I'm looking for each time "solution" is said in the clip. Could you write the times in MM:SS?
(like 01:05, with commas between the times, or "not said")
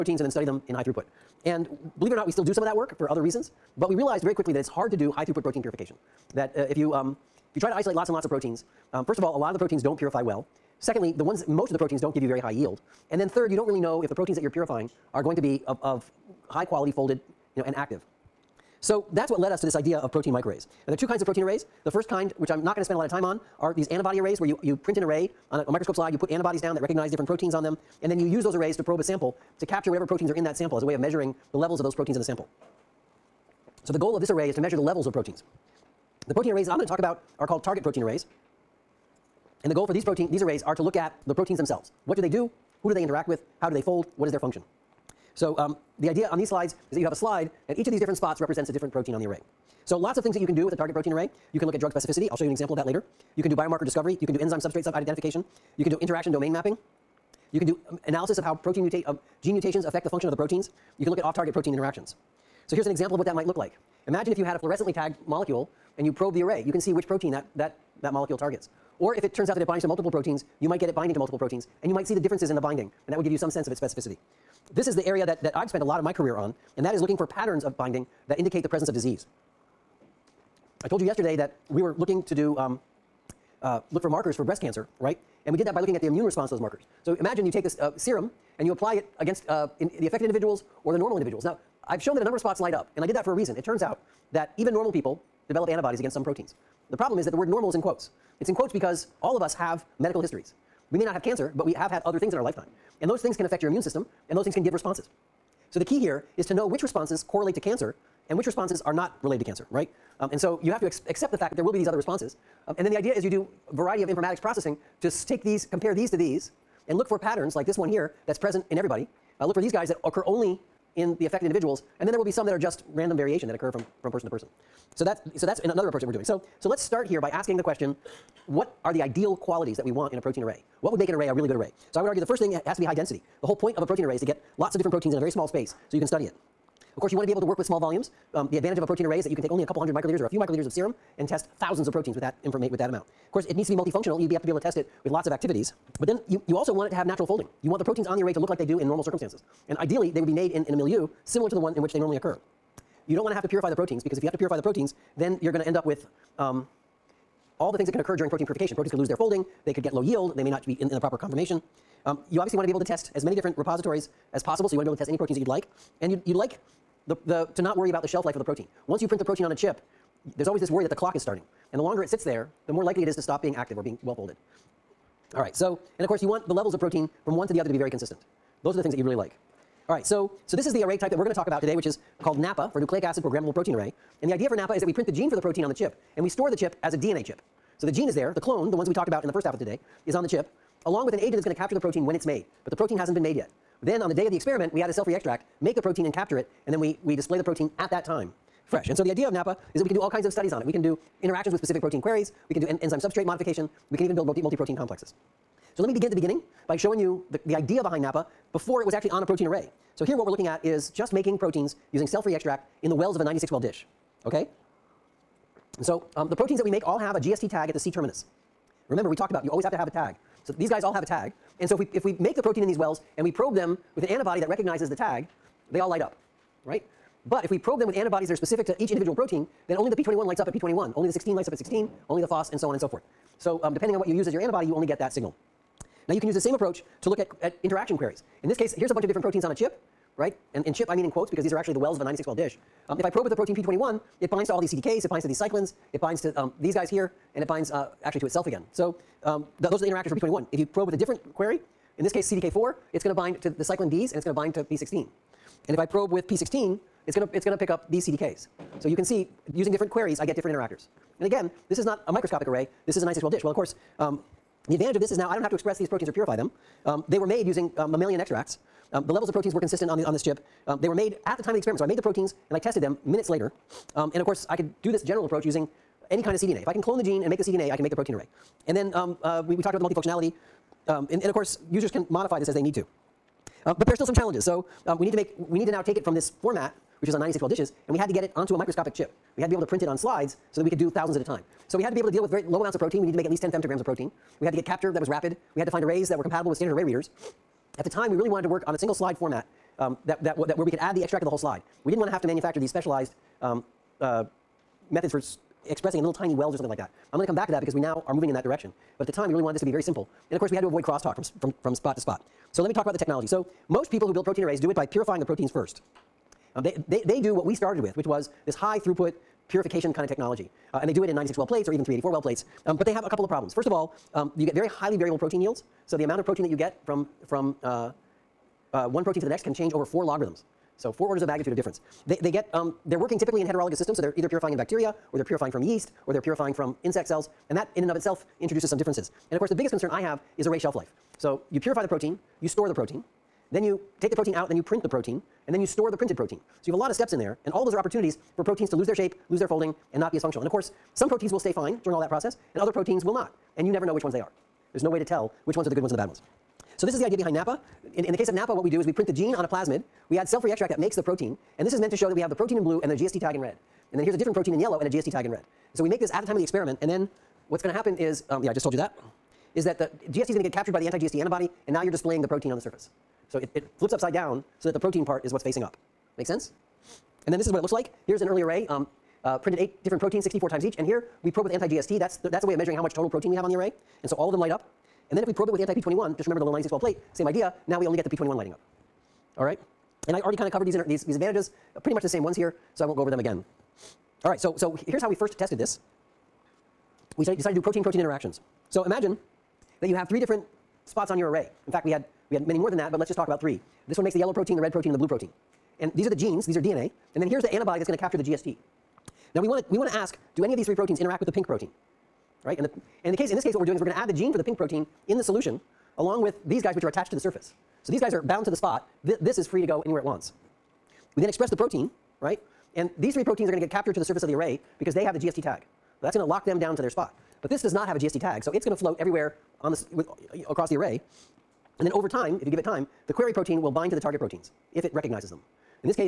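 06:55.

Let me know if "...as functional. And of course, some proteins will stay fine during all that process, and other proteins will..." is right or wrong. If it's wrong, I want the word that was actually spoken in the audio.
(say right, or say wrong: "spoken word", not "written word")
right.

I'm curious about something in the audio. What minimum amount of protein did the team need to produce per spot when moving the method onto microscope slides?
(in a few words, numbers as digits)
10 femtograms.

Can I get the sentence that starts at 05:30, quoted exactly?
So four orders of magnitude of difference.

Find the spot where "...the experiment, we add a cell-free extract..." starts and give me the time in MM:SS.
03:14.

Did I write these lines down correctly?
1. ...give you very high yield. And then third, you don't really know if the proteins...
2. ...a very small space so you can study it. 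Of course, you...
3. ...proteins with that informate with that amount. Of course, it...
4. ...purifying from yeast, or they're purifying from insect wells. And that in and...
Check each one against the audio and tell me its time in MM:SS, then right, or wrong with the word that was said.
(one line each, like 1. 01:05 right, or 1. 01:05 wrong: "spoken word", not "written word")
1. 00:12 right
2. 02:15 right
3. 02:21 right
4. 05:35 wrong: "cells", not "wells".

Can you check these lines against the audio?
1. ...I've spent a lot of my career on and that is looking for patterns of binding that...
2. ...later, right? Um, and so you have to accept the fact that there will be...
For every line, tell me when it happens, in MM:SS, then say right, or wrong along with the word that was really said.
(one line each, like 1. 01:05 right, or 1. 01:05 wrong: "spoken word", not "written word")
1. 01:15 right
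2. 01:49 wrong: "cancer", not "later".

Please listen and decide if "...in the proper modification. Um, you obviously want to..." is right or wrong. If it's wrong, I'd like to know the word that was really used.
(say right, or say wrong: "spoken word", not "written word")
wrong: "conformation", not "modification".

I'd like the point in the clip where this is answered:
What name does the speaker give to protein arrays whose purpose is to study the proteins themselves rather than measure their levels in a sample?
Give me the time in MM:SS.
00:37.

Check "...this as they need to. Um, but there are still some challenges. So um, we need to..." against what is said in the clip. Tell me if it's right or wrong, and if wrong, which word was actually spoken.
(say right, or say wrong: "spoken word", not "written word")
right.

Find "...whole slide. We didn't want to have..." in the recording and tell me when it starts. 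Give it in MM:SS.
05:01.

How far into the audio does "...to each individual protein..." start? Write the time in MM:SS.
03:48.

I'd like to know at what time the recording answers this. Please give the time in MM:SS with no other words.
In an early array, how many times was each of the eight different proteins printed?
06:20.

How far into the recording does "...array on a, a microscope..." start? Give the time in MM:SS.
00:25.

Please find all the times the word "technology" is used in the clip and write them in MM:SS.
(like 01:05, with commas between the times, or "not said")
05:12, 05:20.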